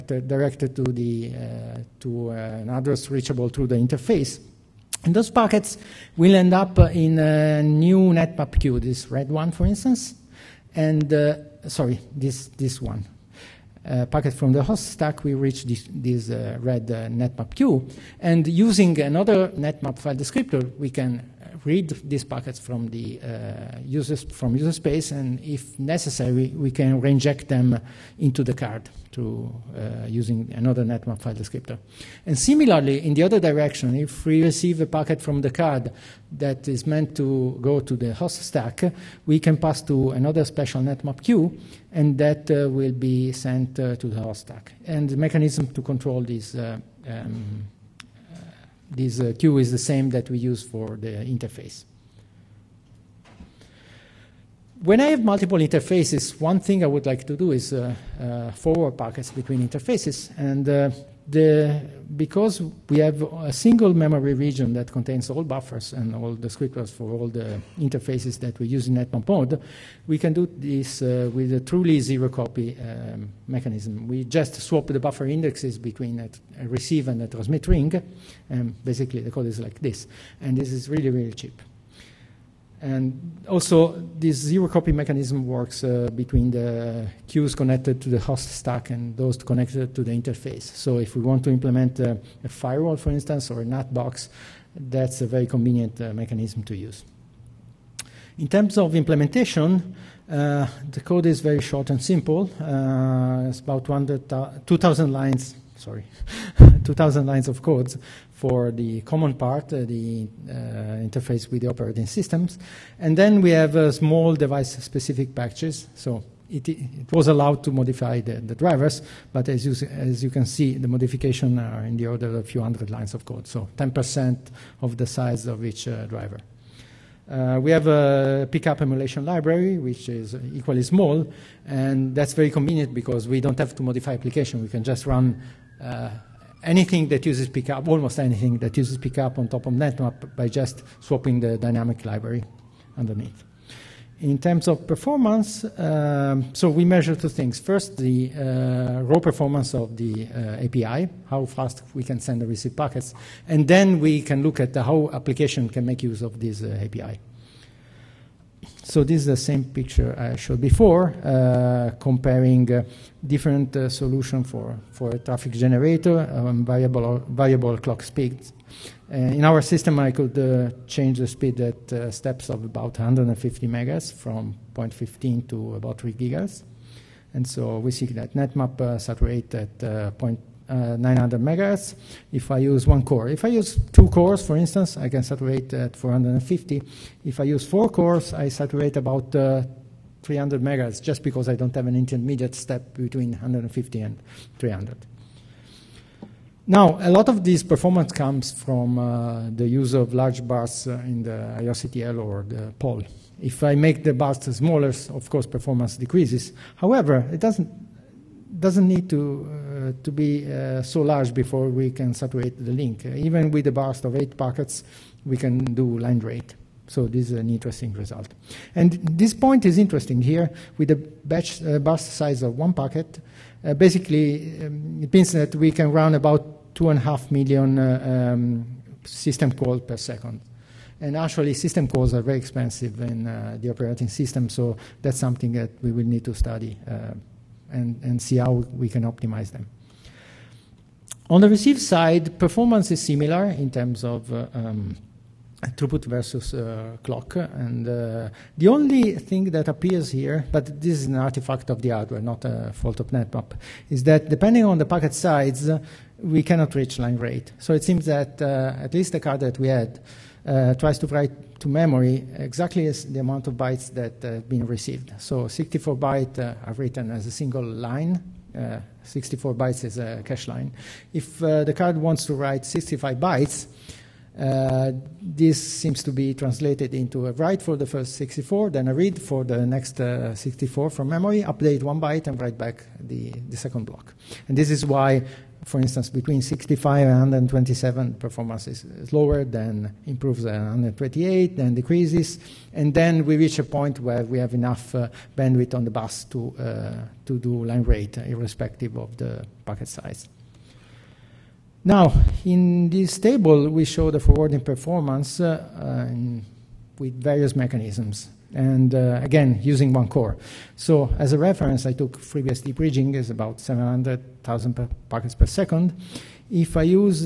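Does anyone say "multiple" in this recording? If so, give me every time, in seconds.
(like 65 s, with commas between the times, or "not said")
55 s.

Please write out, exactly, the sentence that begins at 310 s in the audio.
So as a reference, I took FreeBSD bridging is about 700,000 packets per second.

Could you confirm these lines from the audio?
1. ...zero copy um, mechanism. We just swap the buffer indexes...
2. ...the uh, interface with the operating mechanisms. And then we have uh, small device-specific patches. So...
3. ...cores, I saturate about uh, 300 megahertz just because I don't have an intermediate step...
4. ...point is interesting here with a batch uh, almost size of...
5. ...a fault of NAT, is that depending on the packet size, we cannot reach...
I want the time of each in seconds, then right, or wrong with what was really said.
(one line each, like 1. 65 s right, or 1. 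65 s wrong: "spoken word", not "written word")
1. 71 s right
2. 109 s wrong: "systems", not "mechanisms"
3. 187 s right
4. 219 s wrong: "burst", not "almost"
5. 252 s wrong: "NetMap", not "NAT".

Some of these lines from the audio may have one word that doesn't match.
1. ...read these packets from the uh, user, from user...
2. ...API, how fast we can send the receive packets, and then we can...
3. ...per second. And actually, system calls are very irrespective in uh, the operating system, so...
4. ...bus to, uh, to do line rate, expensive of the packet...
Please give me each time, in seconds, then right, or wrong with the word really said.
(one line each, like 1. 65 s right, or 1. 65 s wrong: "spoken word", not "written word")
1. 21 s right
2. 150 s right
3. 229 s wrong: "expensive", not "irrespective"
4. 295 s wrong: "irrespective", not "expensive".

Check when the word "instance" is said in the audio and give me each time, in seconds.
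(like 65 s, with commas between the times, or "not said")
9 s, 93 s, 184 s, 285 s.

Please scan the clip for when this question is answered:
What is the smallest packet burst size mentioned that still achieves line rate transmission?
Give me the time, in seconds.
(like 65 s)
214 s.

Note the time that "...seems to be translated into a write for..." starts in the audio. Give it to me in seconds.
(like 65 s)
275 s.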